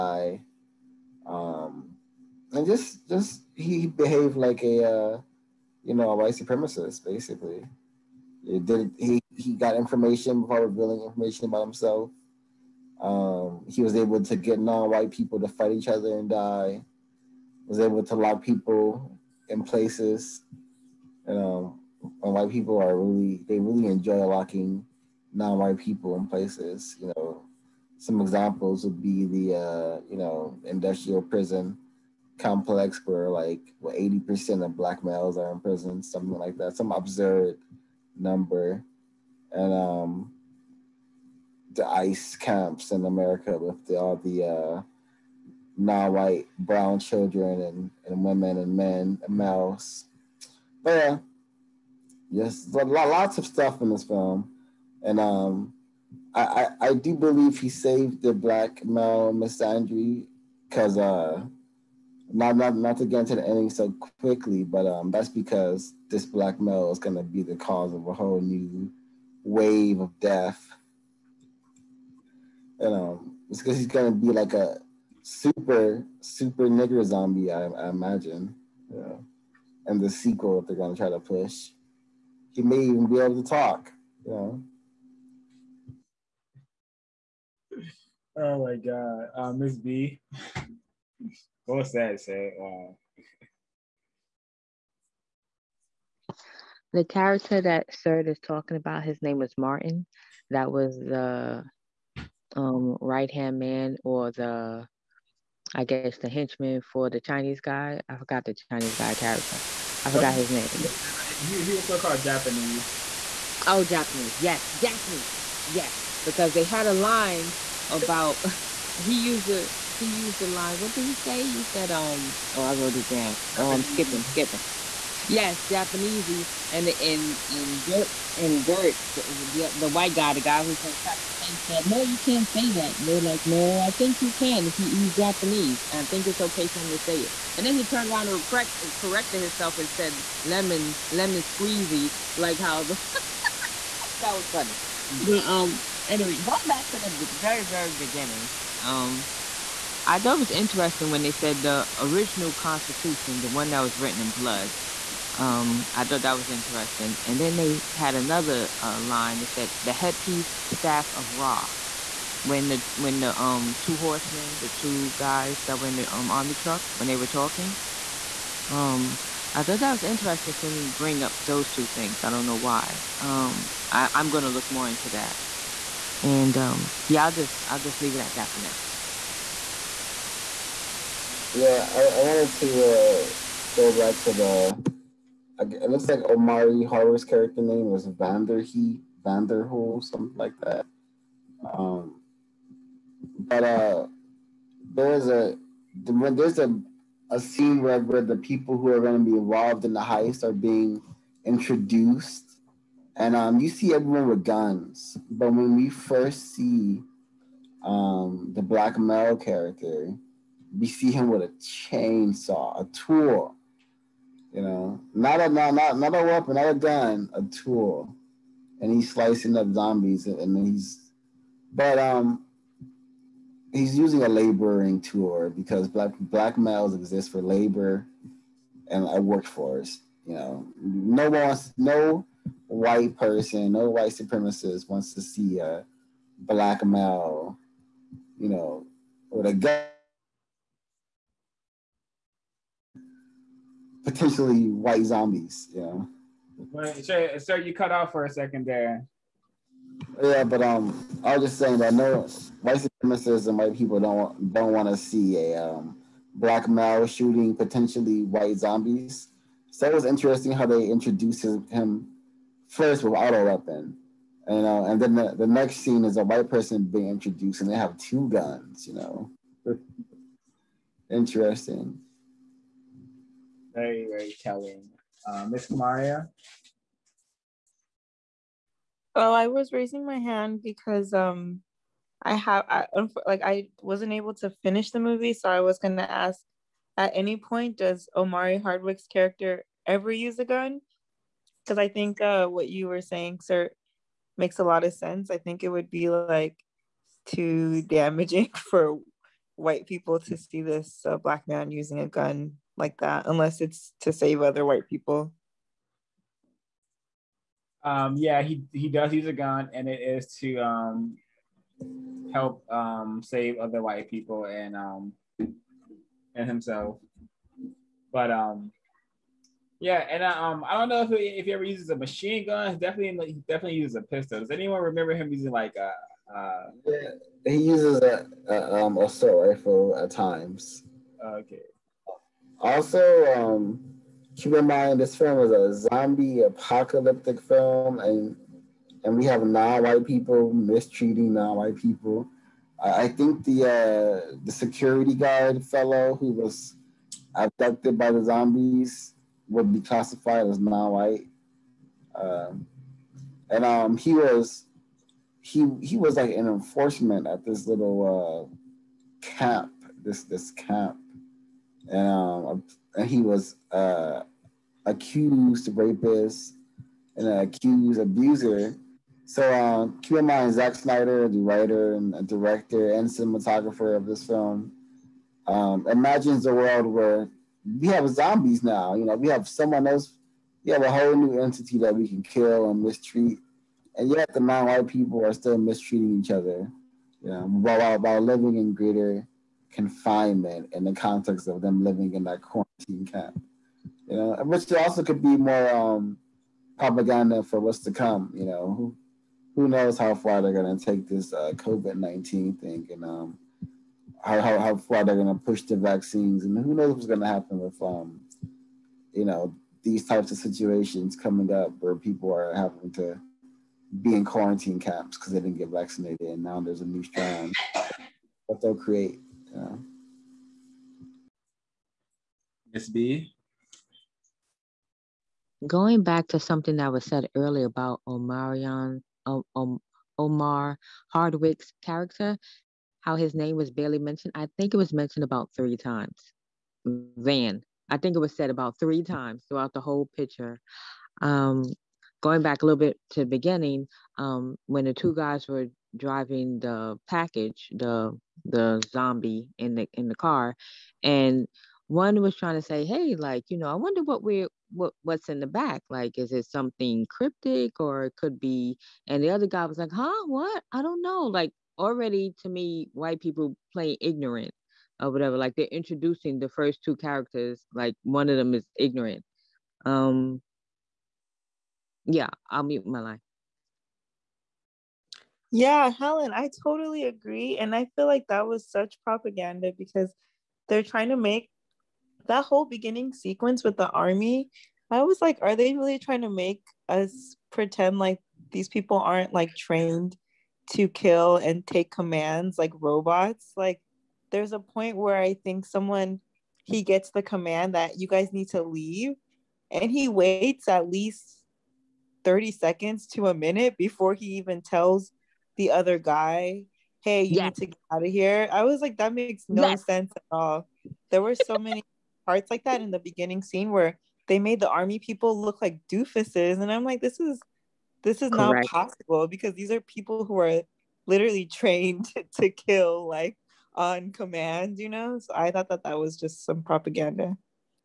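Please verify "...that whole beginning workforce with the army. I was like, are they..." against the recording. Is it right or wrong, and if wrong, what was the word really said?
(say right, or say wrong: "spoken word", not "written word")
wrong: "sequence", not "workforce".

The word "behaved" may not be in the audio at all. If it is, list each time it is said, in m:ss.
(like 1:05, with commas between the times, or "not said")
0:03.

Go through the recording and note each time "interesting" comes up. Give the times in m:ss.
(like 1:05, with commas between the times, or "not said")
2:30, 2:36, 2:50, 4:20, 4:31.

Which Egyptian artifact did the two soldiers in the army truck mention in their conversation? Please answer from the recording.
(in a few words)
headpiece staff of Ra.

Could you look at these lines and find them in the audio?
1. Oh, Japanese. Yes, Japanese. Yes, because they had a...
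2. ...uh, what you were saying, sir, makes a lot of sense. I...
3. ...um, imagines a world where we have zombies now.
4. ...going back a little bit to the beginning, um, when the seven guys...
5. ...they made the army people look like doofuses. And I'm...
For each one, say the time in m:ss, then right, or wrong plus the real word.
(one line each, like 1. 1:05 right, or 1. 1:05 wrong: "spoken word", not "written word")
1. 1:53 right
2. 4:52 right
3. 6:15 right
4. 7:22 wrong: "two", not "seven"
5. 8:34 right.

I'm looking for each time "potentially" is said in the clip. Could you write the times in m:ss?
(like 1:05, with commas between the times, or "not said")
4:04, 4:17.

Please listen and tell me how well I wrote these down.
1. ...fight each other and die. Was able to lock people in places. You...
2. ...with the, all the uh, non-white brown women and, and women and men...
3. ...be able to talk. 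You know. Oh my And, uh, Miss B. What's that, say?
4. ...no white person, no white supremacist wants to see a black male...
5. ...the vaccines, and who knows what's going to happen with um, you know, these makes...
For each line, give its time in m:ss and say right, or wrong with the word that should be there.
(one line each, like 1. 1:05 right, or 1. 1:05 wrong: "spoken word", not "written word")
1. 0:15 right
2. 0:43 wrong: "children", not "women"
3. 1:23 wrong: "God", not "And"
4. 3:51 right
5. 6:45 wrong: "types", not "makes".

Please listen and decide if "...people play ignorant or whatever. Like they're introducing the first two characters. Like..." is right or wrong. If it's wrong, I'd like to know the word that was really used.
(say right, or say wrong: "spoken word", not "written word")
right.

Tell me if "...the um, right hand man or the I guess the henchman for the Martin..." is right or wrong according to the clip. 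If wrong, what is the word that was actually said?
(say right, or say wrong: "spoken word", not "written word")
wrong: "Chinese", not "Martin".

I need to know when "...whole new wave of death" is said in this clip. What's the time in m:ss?
1:08.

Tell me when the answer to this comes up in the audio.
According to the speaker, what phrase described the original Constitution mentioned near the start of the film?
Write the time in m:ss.
2:33.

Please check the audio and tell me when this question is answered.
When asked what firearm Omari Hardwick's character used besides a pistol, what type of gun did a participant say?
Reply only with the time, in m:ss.
5:28.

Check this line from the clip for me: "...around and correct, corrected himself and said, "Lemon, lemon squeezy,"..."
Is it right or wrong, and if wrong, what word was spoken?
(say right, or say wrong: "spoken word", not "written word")
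right.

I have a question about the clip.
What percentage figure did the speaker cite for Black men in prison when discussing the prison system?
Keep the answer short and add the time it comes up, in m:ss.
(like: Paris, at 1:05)
80%, at 0:33.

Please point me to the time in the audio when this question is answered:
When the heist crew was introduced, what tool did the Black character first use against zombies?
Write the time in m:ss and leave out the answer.
3:31.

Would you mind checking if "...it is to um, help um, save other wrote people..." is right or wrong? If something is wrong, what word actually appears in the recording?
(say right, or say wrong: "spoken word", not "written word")
wrong: "white", not "wrote".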